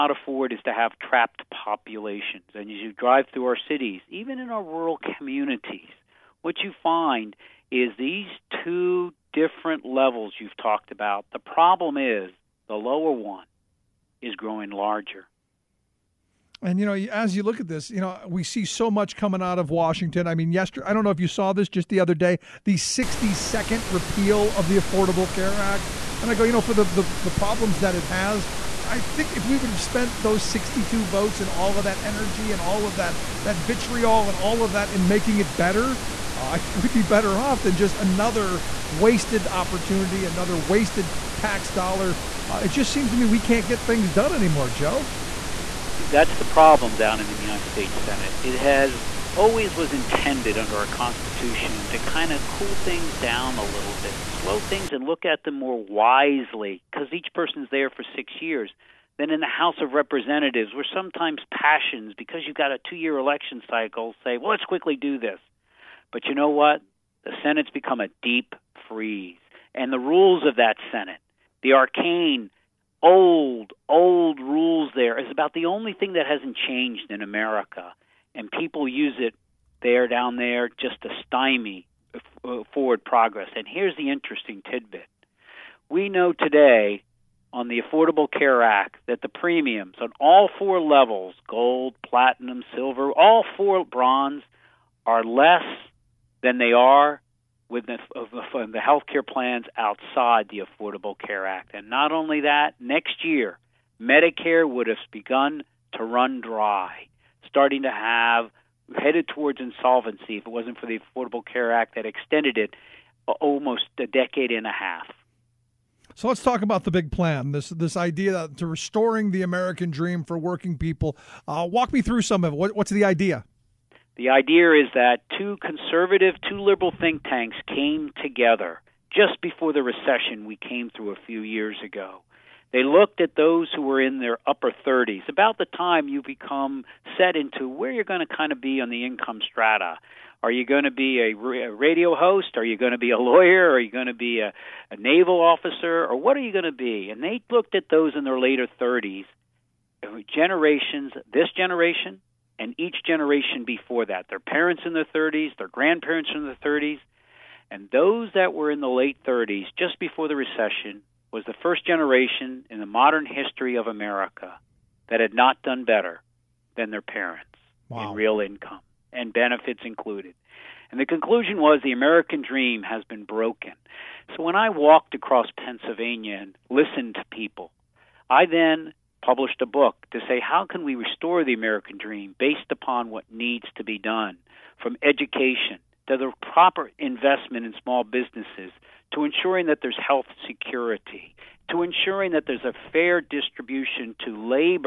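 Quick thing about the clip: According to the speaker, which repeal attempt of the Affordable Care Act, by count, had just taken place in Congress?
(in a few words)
62nd.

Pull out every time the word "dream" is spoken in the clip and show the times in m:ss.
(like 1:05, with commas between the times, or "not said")
1:59, 2:52, 3:01.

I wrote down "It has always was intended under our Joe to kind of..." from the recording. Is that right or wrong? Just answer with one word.
wrong.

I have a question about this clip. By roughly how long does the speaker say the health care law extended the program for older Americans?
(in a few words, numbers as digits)
Almost a decade and a half.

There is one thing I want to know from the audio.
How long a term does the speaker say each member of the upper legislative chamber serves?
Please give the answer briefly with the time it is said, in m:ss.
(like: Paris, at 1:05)
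6 years, at 0:58.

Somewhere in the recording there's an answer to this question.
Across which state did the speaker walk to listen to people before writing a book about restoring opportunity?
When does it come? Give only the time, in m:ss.
2:55.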